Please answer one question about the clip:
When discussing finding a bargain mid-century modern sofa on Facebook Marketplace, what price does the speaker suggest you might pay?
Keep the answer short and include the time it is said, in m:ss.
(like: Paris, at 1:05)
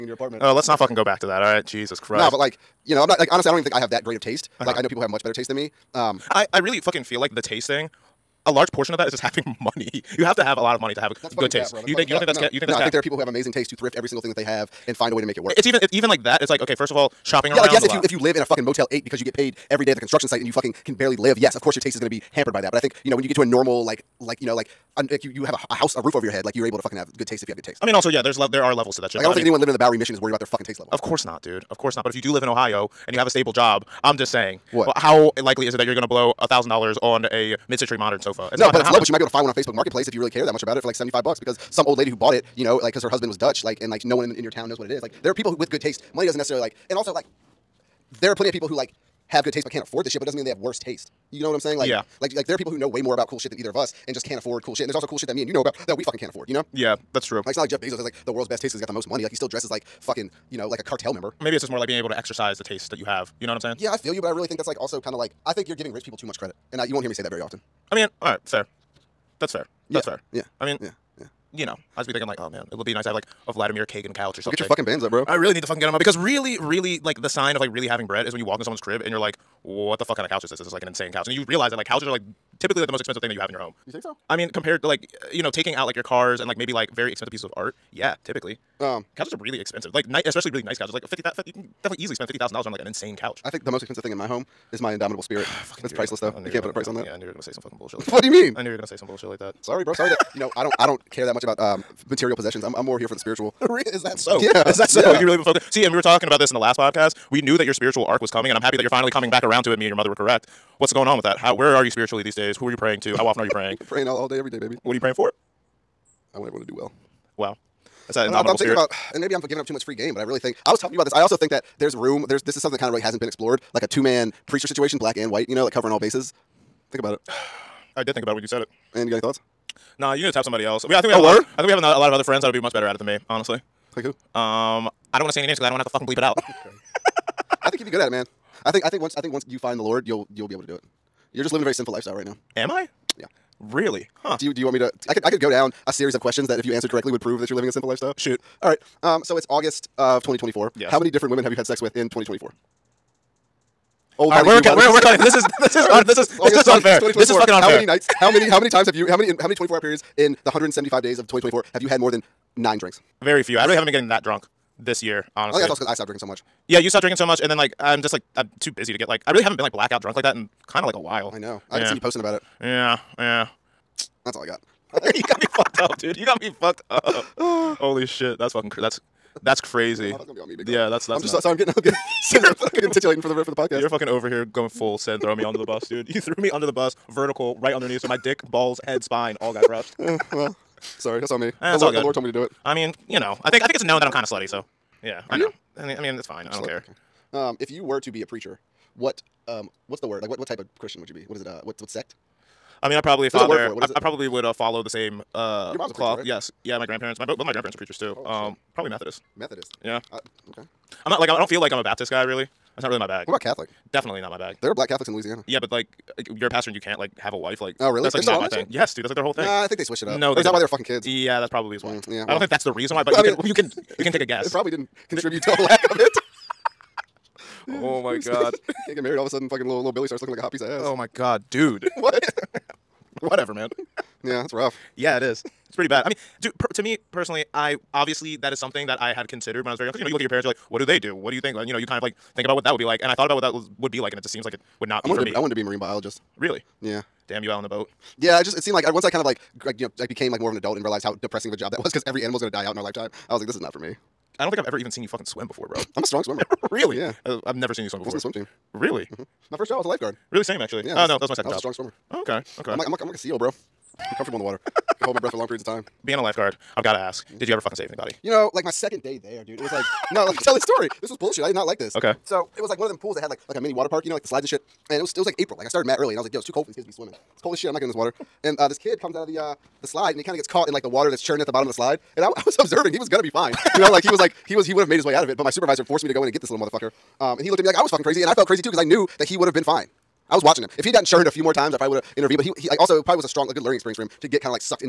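$75, at 0:40.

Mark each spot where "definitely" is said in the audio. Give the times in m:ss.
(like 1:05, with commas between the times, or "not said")
1:31, 3:33.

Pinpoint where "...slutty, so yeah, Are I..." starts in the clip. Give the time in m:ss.
3:14.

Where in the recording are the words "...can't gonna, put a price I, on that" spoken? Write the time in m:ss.
1:36.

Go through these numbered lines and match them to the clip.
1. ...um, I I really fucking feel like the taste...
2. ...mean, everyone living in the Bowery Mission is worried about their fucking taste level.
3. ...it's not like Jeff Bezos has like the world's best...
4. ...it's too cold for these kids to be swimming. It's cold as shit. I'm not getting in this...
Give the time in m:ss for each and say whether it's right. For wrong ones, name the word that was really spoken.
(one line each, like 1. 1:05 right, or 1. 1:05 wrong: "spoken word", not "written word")
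1. 0:05 right
2. 0:29 wrong: "anyone", not "everyone"
3. 0:57 right
4. 4:36 right.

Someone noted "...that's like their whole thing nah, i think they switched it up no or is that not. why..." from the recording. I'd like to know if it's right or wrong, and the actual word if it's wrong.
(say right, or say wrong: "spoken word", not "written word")
right.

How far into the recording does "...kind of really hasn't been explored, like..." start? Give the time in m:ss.
2:02.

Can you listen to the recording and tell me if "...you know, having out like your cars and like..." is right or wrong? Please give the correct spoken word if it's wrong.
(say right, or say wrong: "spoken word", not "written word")
wrong: "taking", not "having".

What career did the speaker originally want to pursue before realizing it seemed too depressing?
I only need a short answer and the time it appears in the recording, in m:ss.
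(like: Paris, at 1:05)
Marine biologist, at 4:05.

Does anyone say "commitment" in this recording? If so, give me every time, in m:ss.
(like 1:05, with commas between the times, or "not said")
not said.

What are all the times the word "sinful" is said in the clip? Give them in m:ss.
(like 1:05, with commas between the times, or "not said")
2:21, 2:27.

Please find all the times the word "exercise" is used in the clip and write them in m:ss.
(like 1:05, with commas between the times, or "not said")
1:02.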